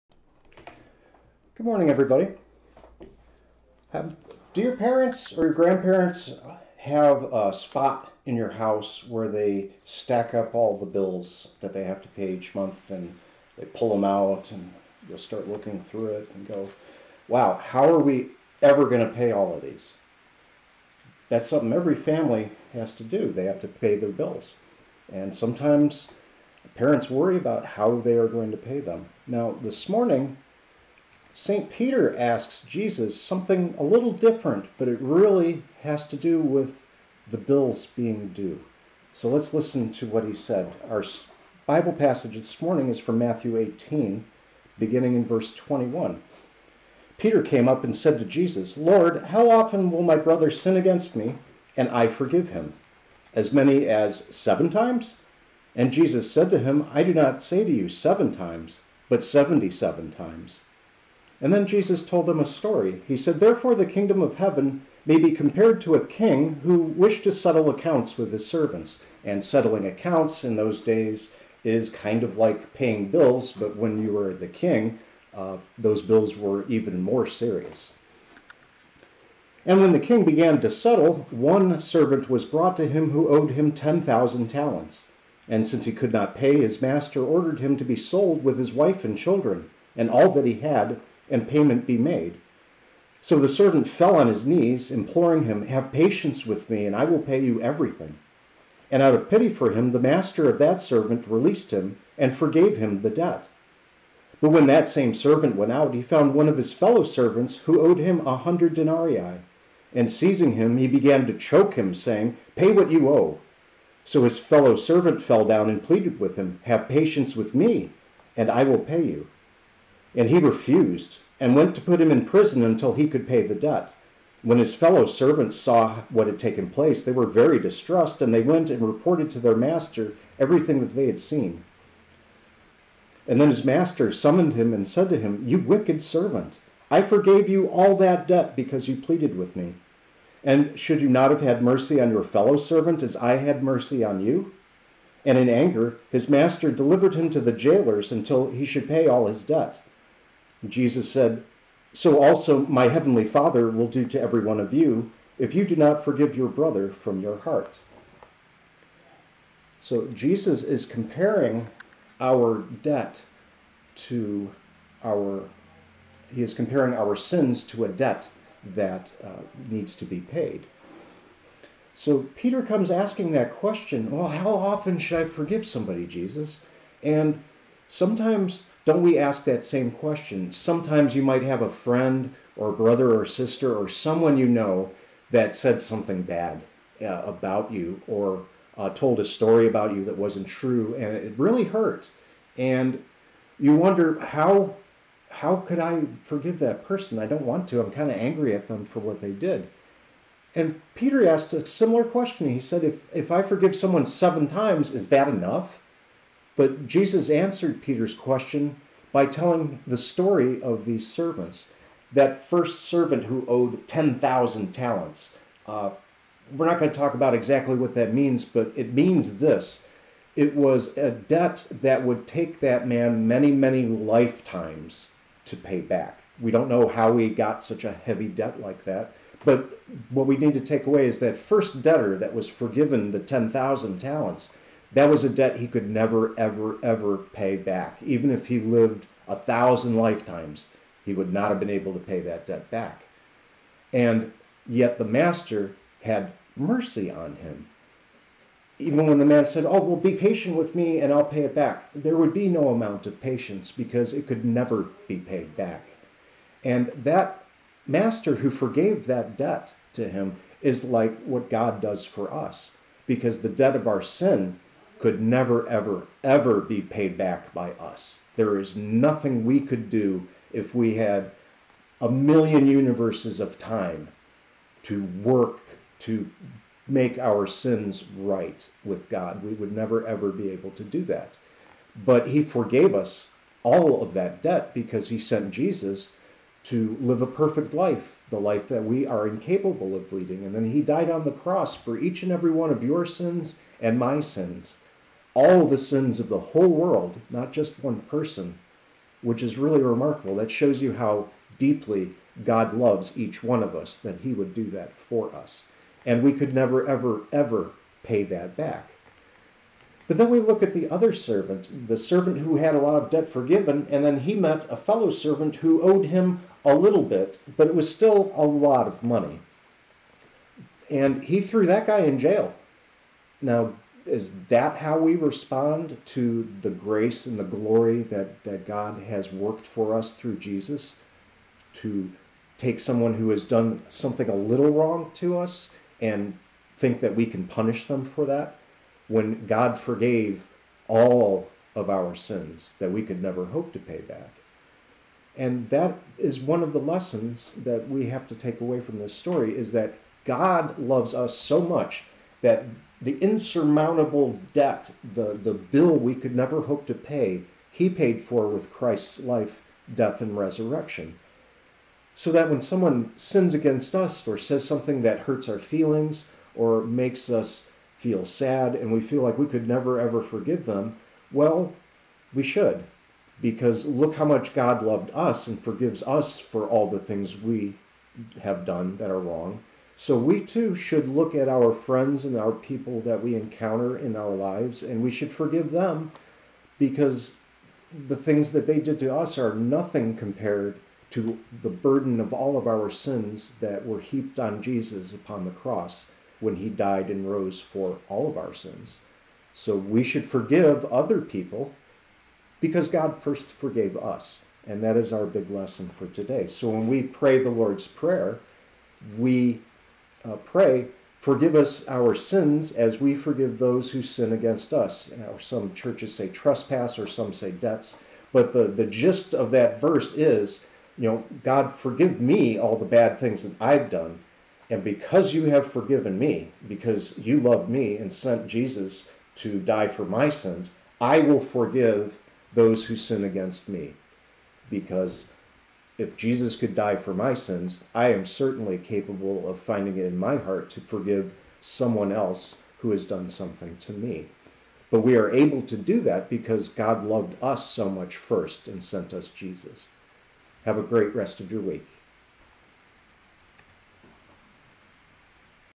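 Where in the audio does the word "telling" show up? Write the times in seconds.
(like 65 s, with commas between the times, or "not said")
209 s.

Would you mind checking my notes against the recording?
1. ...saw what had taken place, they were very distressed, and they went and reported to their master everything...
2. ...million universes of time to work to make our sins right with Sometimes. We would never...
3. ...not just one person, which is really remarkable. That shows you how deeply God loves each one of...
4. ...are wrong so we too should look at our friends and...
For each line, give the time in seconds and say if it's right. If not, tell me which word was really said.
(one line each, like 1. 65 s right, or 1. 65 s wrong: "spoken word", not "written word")
1. 125 s right
2. 272 s wrong: "God", not "Sometimes"
3. 297 s right
4. 379 s right.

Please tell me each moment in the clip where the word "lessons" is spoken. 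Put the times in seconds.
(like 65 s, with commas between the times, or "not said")
346 s, 405 s.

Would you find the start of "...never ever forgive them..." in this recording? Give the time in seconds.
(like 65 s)
369 s.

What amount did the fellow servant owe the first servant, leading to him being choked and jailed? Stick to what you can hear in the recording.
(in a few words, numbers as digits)
100 denarii.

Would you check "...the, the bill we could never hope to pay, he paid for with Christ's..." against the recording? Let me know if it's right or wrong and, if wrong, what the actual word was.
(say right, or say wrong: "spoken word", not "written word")
right.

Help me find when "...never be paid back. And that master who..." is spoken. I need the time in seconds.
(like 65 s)
254 s.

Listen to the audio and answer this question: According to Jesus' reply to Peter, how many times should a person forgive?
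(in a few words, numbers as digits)
77.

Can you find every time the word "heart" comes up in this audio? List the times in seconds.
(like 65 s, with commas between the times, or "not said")
157 s, 440 s.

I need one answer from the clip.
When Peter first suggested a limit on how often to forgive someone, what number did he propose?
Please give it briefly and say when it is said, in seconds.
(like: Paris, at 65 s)
7, at 53 s.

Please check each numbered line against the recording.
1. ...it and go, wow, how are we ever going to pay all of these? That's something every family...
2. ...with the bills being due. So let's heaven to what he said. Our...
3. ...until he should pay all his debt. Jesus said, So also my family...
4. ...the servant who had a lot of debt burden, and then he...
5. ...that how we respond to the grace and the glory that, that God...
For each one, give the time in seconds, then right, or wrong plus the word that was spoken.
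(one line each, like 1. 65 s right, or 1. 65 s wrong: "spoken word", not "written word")
1. 16 s right
2. 36 s wrong: "listen", not "heaven"
3. 148 s wrong: "heavenly", not "family"
4. 311 s wrong: "forgiven", not "burden"
5. 324 s right.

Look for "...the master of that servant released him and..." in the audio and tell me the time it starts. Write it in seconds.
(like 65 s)
99 s.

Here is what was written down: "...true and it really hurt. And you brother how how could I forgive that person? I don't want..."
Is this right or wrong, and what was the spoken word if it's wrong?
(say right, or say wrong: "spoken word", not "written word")
wrong: "wonder", not "brother".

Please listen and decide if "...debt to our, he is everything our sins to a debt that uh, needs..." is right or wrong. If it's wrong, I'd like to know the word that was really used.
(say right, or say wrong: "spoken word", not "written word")
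wrong: "comparing", not "everything".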